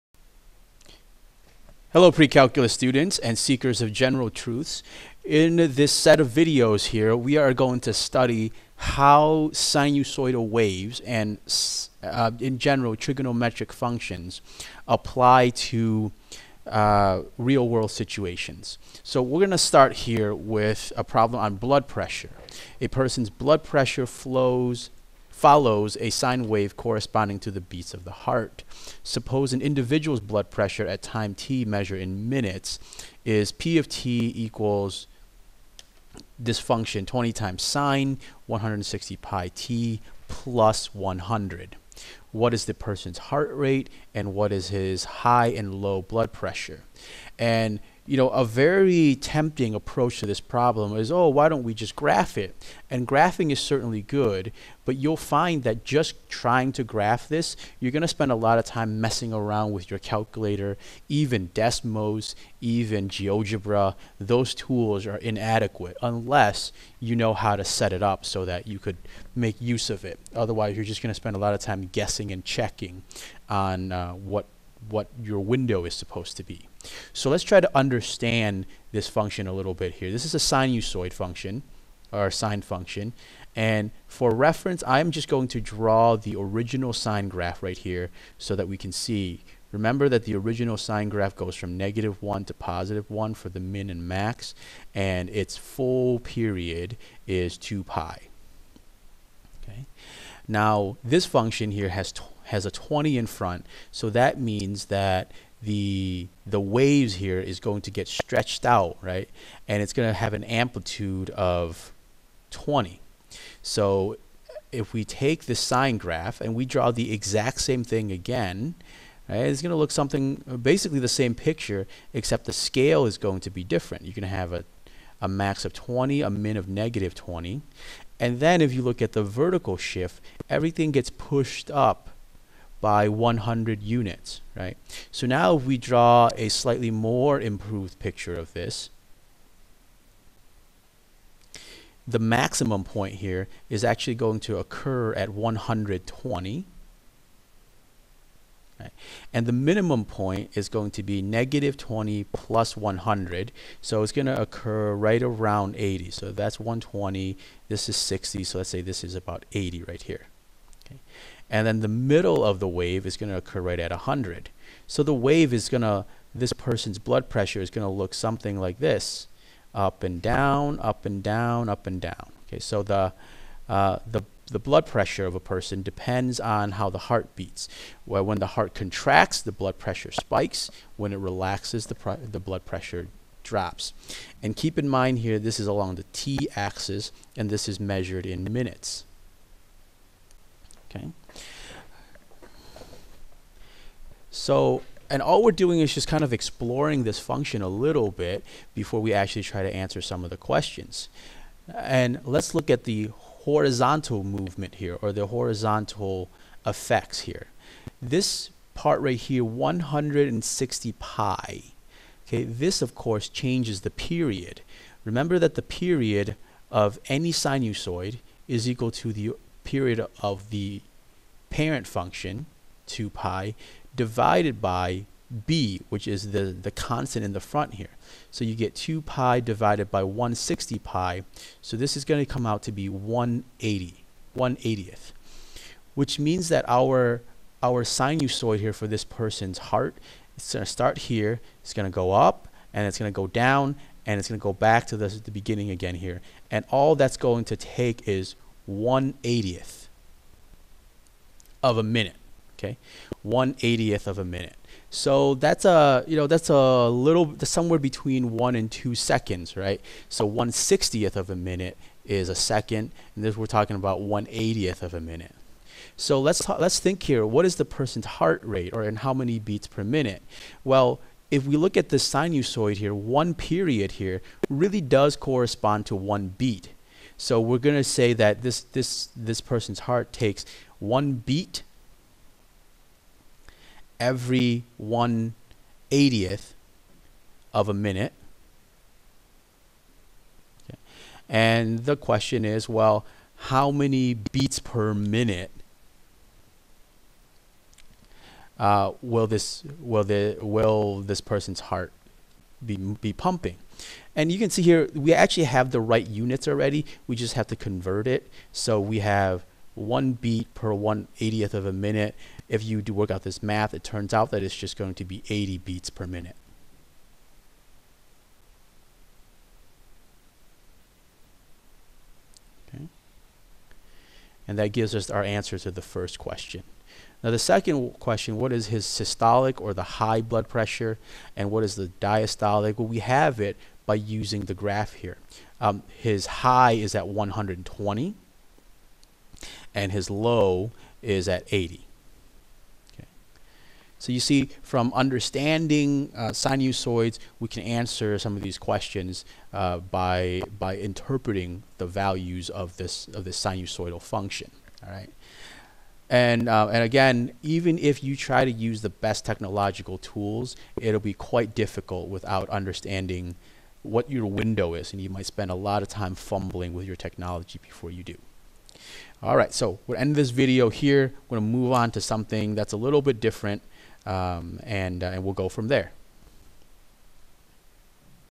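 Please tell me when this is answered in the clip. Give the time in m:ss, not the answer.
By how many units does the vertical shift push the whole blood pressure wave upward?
2:11.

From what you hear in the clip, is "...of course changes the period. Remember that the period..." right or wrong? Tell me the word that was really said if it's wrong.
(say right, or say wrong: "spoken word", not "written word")
right.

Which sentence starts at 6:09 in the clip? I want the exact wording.
All right, so we'll end this video here.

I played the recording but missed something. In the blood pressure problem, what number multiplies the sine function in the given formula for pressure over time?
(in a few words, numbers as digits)
20.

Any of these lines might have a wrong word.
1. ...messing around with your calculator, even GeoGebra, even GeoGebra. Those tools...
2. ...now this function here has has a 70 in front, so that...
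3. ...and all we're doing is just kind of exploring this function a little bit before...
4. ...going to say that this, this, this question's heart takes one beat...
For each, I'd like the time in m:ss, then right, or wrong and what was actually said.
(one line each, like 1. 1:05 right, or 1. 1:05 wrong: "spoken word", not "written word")
1. 0:58 wrong: "Desmos", not "GeoGebra"
2. 1:40 wrong: "20", not "70"
3. 3:15 right
4. 4:37 wrong: "person", not "question".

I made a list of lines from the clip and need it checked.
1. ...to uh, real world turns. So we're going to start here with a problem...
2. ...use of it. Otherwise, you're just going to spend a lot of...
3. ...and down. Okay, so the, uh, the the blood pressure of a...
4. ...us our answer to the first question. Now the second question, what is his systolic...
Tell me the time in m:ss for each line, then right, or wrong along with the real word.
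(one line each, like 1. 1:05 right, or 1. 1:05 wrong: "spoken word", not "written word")
1. 0:15 wrong: "situations", not "turns"
2. 1:09 right
3. 2:51 right
4. 5:24 right.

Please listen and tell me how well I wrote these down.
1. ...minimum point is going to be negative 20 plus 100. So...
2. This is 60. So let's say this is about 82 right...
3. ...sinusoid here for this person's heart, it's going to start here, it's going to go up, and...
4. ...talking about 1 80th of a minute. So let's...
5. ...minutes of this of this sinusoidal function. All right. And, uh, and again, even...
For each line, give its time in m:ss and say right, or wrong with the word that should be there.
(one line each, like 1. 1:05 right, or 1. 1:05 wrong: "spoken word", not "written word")
1. 2:29 right
2. 2:37 wrong: "80", not "82"
3. 3:57 right
4. 4:23 right
5. 5:51 wrong: "values", not "minutes".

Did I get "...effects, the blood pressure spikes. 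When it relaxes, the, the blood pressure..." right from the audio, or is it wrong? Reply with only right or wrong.
wrong.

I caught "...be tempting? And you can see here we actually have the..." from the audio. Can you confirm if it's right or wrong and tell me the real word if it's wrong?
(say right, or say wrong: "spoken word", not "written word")
wrong: "pumping", not "tempting".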